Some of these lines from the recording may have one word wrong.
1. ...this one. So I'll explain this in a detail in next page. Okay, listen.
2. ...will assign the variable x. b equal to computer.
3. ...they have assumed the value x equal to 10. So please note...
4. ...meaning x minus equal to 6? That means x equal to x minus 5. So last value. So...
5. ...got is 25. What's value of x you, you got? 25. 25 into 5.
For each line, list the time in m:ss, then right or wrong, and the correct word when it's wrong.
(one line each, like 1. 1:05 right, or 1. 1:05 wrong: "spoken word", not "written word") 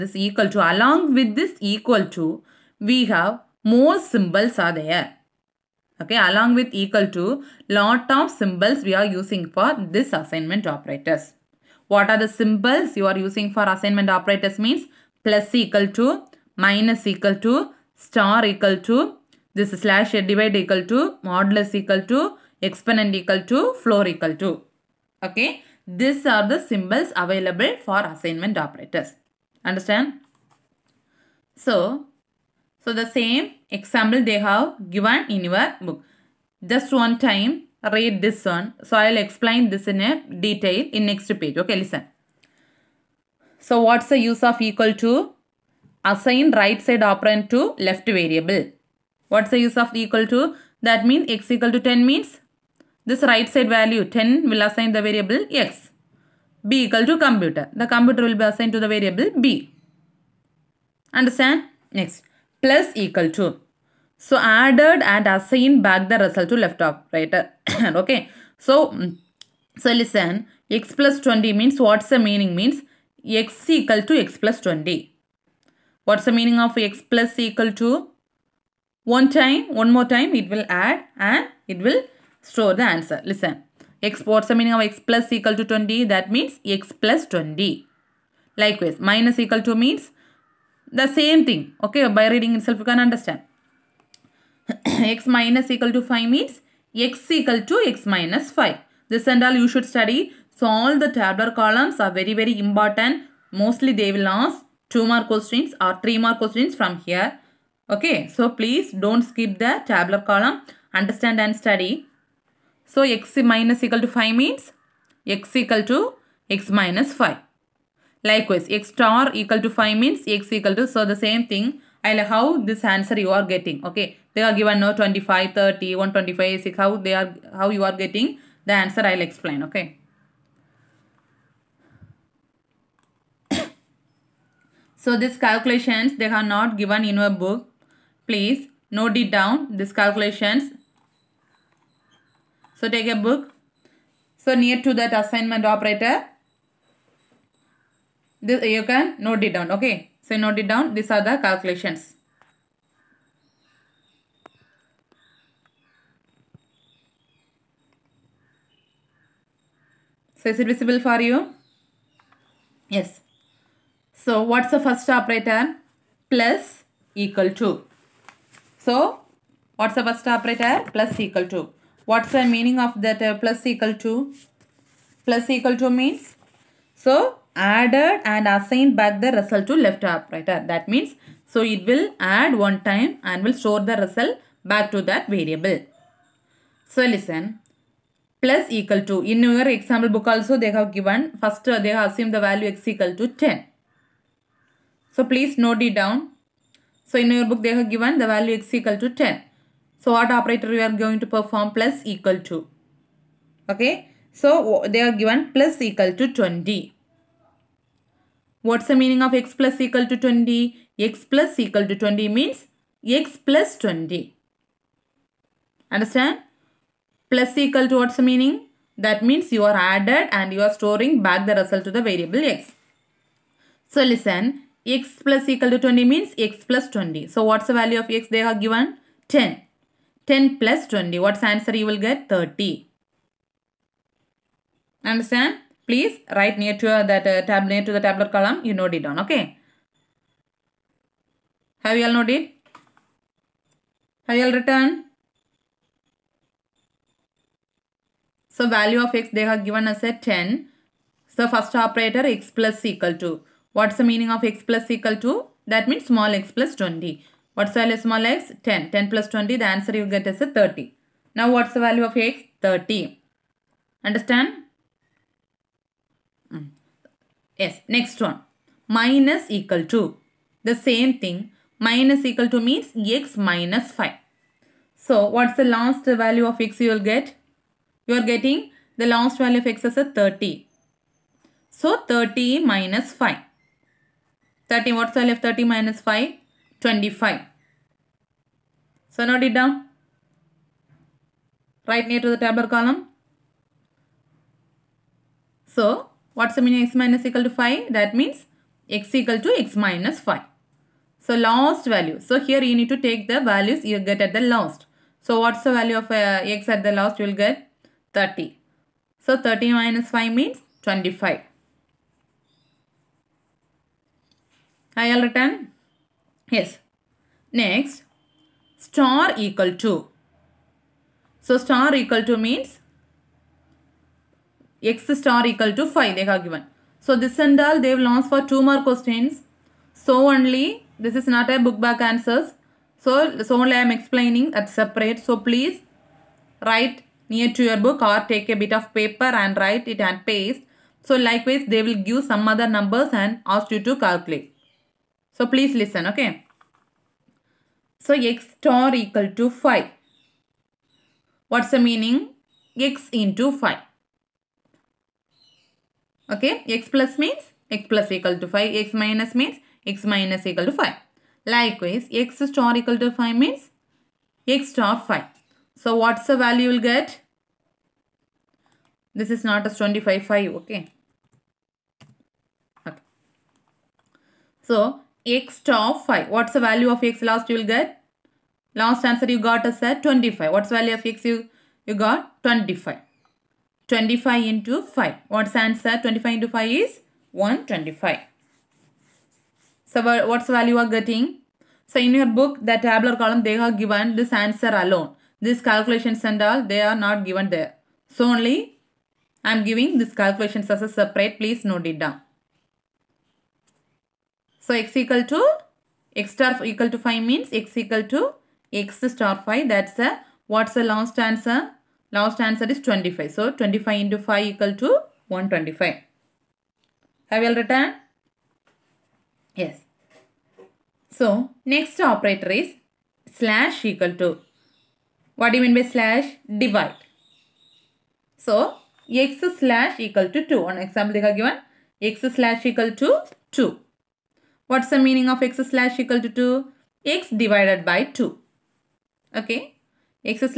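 1. 0:38 right
2. 0:54 right
3. 3:11 right
4. 4:56 wrong: "5", not "6"
5. 6:19 right.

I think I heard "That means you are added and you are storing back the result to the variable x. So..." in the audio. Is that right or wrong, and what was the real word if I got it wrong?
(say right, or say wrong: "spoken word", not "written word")
right.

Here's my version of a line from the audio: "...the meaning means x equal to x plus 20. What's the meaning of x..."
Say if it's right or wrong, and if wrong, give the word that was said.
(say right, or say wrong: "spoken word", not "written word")
right.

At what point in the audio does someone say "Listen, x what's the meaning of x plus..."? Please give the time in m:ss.
1:23.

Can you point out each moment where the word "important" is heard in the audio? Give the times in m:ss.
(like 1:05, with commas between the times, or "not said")
1:42.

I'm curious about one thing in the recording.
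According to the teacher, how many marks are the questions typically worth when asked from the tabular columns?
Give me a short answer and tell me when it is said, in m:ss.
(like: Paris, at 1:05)
2 or 3 marks, at 1:44.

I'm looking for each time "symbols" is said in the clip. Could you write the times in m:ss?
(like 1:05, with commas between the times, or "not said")
0:04, 0:08, 0:12, 0:26.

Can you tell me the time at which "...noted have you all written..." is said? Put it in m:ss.
4:02.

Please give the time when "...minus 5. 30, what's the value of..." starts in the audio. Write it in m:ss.
4:42.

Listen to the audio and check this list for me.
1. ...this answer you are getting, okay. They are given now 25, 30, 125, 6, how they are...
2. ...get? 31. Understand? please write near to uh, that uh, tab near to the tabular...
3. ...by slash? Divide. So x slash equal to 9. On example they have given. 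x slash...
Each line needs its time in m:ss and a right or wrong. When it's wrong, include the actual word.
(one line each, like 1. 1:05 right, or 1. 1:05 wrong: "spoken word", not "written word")
1. 2:02 right
2. 3:51 wrong: "30", not "31"
3. 7:05 wrong: "2", not "9".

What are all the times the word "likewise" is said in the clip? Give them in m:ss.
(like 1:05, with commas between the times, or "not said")
1:28, 1:58, 5:41, 6:01.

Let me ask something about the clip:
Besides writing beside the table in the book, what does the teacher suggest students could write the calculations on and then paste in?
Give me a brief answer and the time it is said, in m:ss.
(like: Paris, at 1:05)
a bit of paper, at 5:38.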